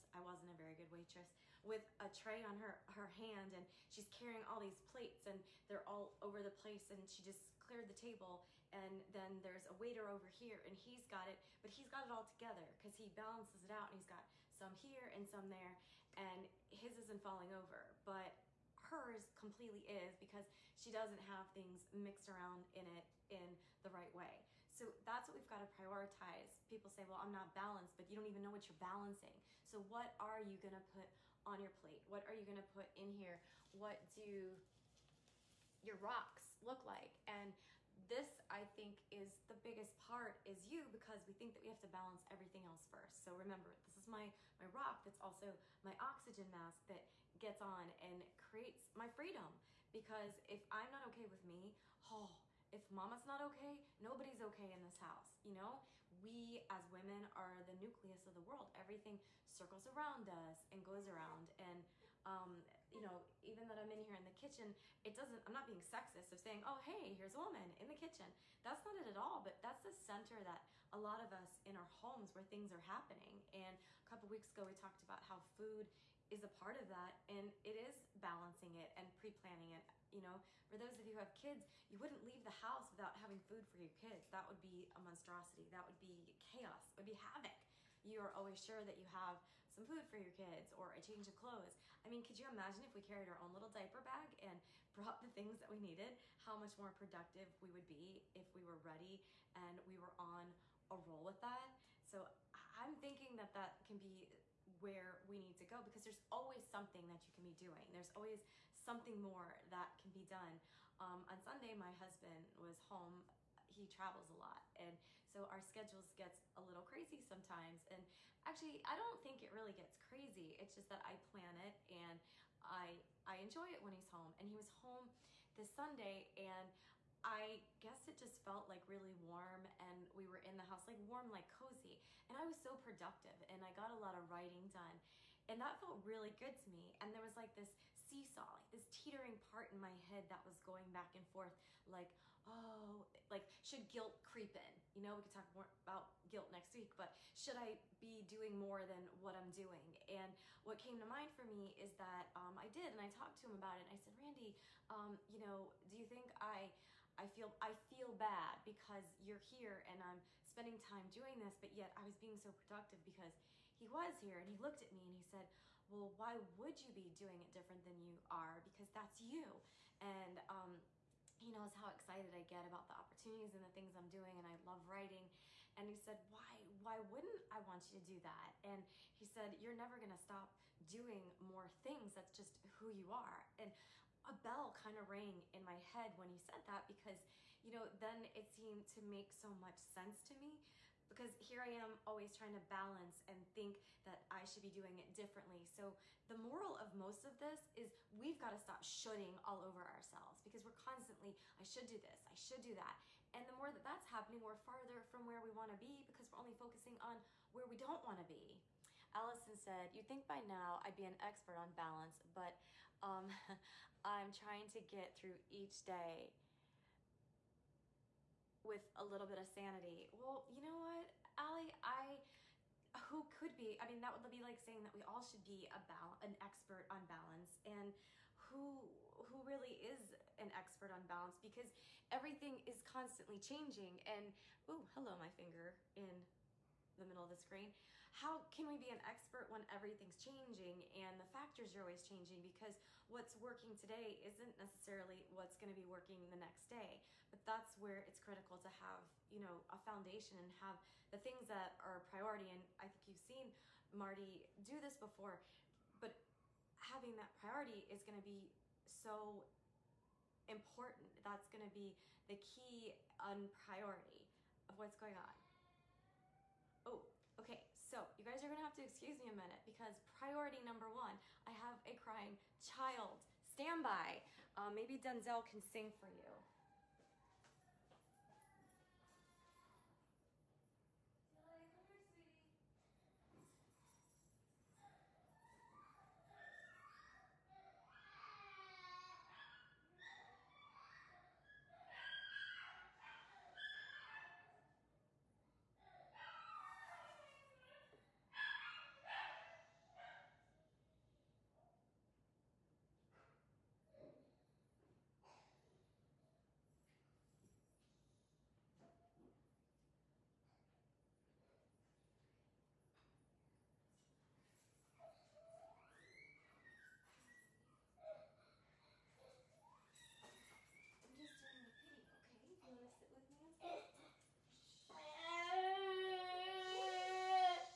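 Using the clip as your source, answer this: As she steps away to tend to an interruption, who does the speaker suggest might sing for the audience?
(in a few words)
Denzel.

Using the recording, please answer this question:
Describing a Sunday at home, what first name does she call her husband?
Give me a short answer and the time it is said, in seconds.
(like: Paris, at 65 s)
Randy, at 154 s.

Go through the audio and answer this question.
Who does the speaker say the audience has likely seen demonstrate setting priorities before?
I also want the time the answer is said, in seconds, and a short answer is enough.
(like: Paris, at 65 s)
Marty, at 253 s.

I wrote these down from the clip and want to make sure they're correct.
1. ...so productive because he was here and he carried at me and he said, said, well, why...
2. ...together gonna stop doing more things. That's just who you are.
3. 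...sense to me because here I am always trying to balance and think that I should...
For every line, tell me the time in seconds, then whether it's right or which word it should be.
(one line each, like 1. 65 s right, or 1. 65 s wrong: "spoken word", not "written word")
1. 162 s wrong: "looked", not "carried"
2. 179 s wrong: "never", not "together"
3. 189 s right.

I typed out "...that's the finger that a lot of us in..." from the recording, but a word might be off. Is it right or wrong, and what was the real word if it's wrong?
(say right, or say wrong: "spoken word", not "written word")
wrong: "center", not "finger".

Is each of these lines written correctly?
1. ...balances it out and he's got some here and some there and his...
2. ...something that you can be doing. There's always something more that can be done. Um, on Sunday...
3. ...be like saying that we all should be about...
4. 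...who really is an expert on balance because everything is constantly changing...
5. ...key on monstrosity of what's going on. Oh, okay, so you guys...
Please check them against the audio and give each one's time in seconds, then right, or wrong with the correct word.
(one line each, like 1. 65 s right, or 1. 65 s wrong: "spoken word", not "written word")
1. 13 s right
2. 106 s right
3. 224 s right
4. 229 s right
5. 262 s wrong: "priority", not "monstrosity".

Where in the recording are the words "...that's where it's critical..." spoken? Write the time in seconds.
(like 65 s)
247 s.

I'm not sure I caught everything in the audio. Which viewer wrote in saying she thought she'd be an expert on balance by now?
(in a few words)
Allison.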